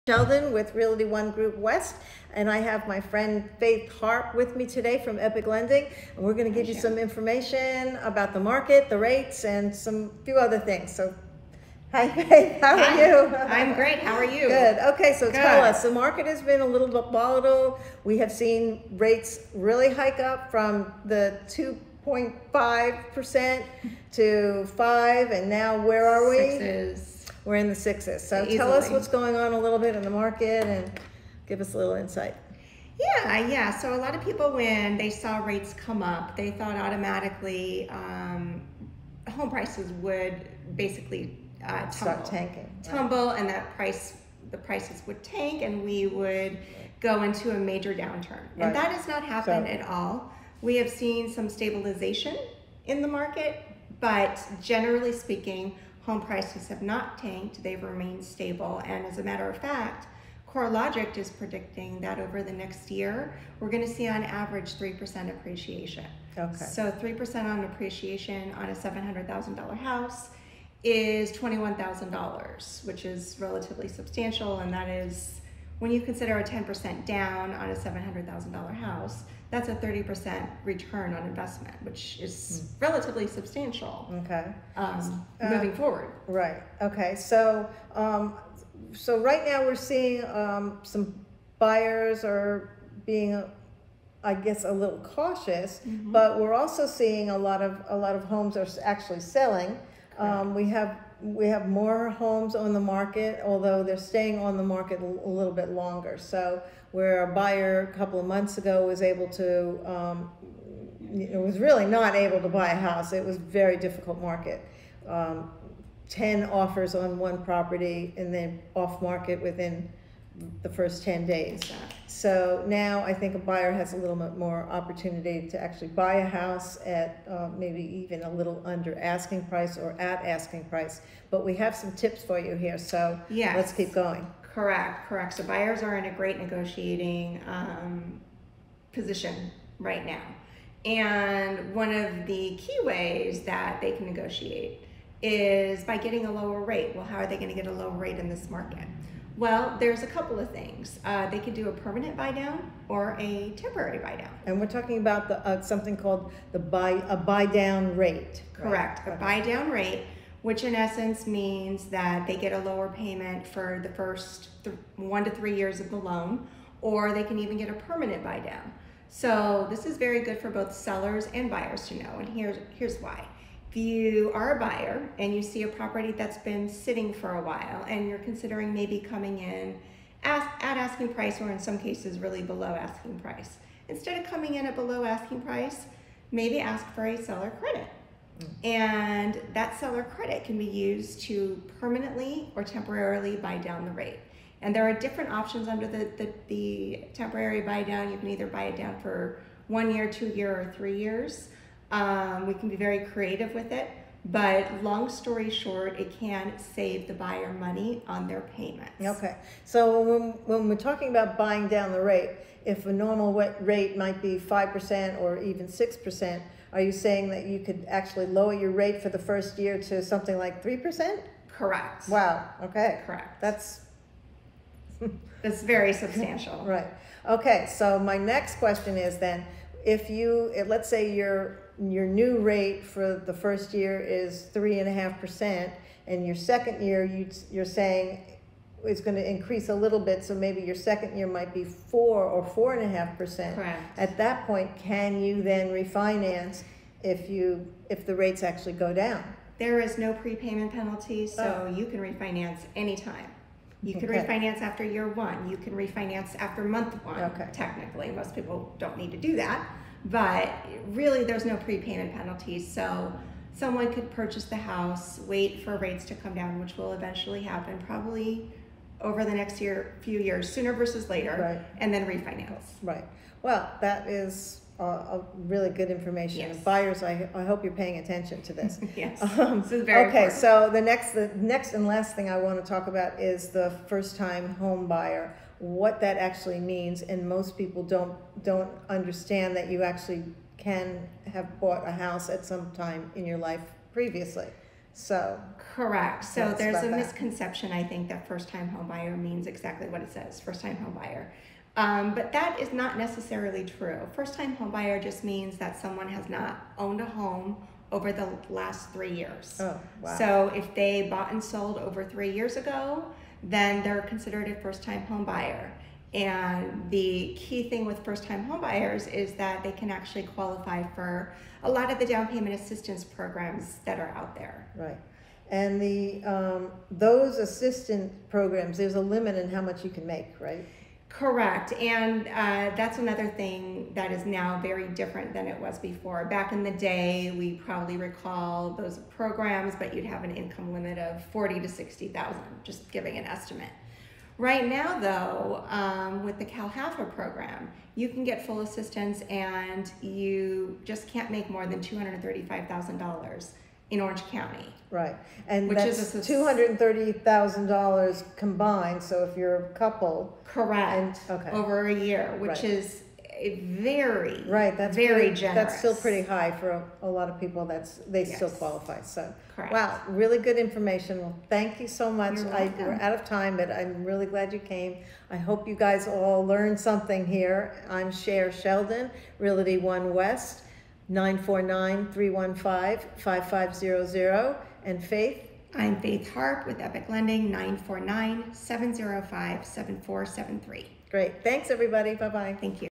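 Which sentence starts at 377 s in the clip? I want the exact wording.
I'm Sher Sheldon, Realty One West, 949-315-5500.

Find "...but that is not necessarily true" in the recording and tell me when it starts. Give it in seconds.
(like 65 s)
302 s.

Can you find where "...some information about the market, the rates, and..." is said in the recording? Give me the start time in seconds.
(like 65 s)
6 s.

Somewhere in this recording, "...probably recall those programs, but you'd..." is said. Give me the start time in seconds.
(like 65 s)
337 s.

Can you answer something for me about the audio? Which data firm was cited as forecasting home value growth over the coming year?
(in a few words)
CoreLogic.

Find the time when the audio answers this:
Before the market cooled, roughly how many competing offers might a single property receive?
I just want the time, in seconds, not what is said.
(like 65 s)
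116 s.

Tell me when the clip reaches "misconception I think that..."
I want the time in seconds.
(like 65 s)
296 s.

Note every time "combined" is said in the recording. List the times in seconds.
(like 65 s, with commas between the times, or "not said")
358 s.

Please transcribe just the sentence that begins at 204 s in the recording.
But long story short, it can save the buyer money on their payments.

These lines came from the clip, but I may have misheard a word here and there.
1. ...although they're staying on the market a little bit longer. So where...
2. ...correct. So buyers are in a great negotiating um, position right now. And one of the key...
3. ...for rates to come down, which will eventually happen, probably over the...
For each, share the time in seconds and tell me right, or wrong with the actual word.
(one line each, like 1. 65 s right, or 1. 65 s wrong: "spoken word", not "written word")
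1. 103 s right
2. 135 s right
3. 265 s right.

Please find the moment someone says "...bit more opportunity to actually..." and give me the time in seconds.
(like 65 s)
124 s.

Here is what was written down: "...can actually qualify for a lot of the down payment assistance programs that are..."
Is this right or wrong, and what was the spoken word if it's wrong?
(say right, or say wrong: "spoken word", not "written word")
right.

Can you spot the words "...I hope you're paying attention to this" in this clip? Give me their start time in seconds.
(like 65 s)
277 s.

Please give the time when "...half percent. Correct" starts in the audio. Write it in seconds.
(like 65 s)
242 s.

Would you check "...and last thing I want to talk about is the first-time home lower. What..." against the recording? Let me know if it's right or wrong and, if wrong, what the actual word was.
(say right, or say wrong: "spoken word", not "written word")
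wrong: "buyer", not "lower".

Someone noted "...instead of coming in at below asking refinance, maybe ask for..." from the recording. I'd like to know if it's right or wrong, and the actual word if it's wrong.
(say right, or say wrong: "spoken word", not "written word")
wrong: "price", not "refinance".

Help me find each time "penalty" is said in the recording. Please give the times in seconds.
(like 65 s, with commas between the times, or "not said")
250 s, 262 s.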